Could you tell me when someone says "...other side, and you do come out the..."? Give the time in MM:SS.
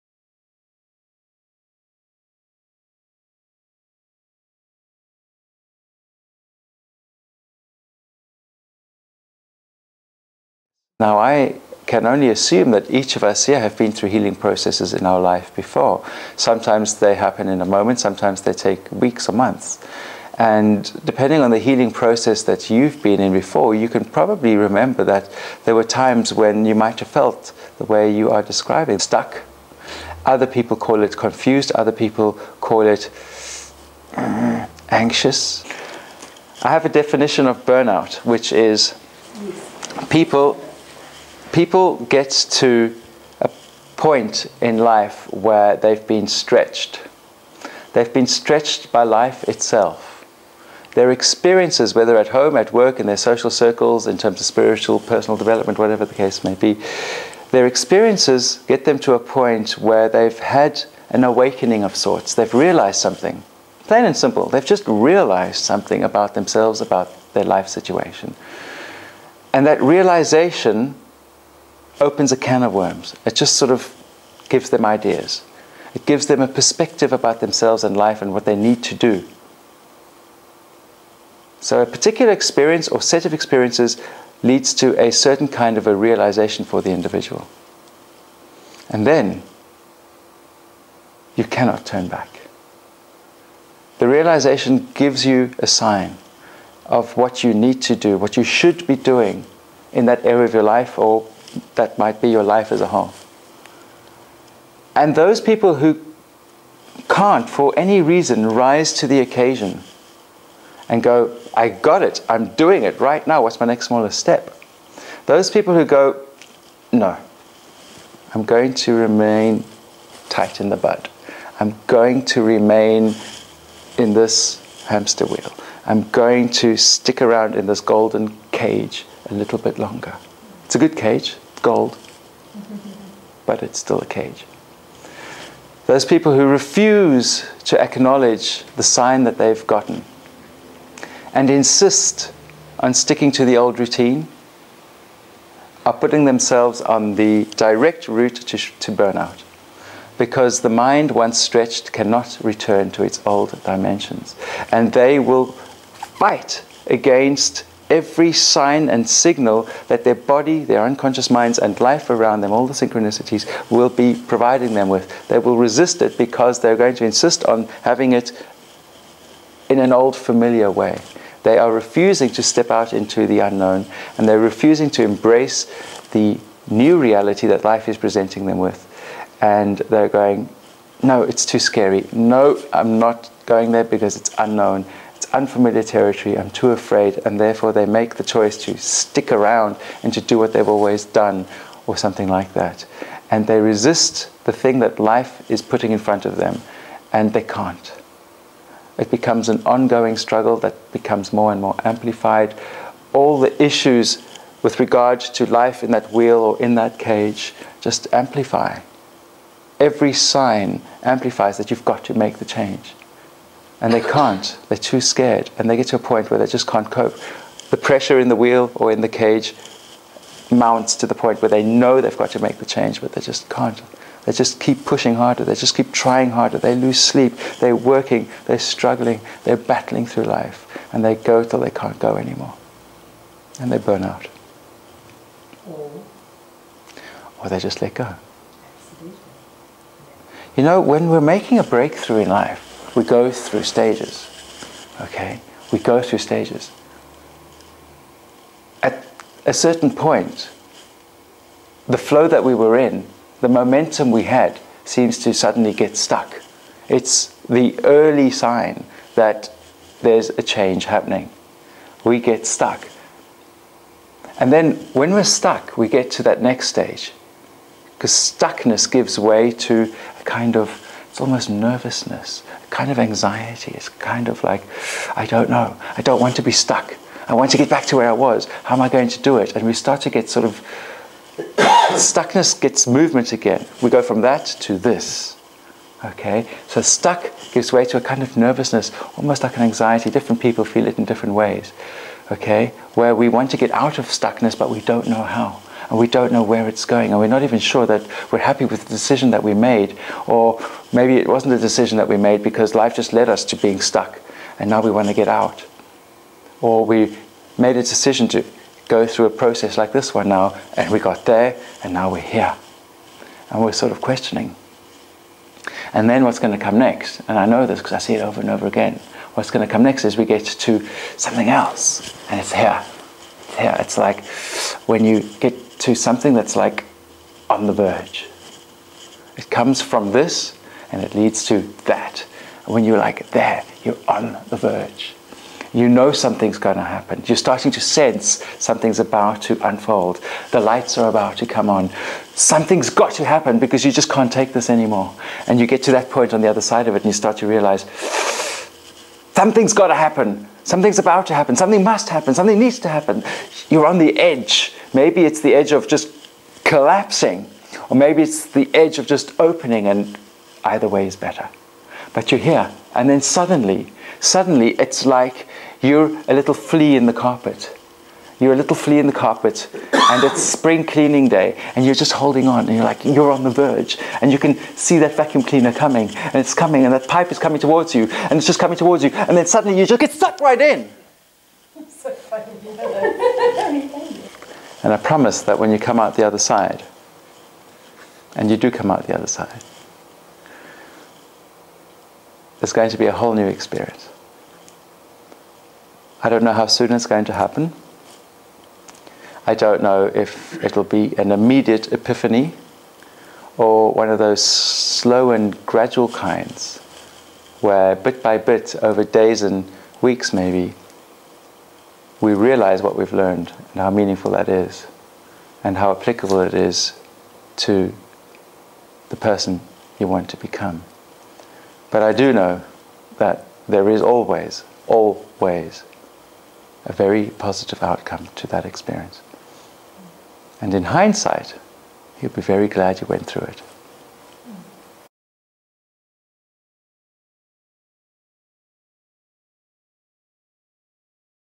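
06:26.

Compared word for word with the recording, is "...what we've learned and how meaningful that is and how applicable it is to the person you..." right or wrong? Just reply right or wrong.
right.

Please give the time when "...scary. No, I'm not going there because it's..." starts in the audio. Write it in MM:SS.
03:01.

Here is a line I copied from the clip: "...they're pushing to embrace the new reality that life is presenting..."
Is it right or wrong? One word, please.
wrong.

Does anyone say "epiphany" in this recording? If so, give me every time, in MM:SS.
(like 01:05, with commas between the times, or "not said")
06:41.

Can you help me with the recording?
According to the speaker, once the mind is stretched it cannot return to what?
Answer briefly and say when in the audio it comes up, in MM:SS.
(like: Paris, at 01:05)
its old dimensions, at 02:33.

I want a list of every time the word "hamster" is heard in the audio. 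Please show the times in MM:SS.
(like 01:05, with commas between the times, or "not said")
02:04.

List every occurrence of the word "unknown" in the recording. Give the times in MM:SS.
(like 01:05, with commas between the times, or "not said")
02:53, 03:04.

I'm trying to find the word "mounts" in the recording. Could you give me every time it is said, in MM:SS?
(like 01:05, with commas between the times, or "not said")
03:40.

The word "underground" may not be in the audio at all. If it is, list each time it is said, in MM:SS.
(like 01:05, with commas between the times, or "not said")
not said.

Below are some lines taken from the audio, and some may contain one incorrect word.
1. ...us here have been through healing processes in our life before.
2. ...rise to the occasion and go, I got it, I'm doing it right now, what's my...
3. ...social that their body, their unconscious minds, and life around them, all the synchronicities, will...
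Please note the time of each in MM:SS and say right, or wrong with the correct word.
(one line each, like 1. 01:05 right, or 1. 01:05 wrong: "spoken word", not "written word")
1. 00:13 right
2. 01:48 right
3. 02:39 wrong: "signal", not "social".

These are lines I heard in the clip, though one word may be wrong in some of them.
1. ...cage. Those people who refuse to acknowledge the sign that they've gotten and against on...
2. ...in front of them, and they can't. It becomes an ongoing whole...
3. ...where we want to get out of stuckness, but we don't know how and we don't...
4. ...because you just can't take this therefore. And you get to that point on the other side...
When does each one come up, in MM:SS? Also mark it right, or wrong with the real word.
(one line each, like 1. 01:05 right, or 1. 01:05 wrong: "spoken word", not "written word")
1. 02:14 wrong: "insist", not "against"
2. 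03:15 wrong: "struggle", not "whole"
3. 04:52 right
4. 05:43 wrong: "anymore", not "therefore".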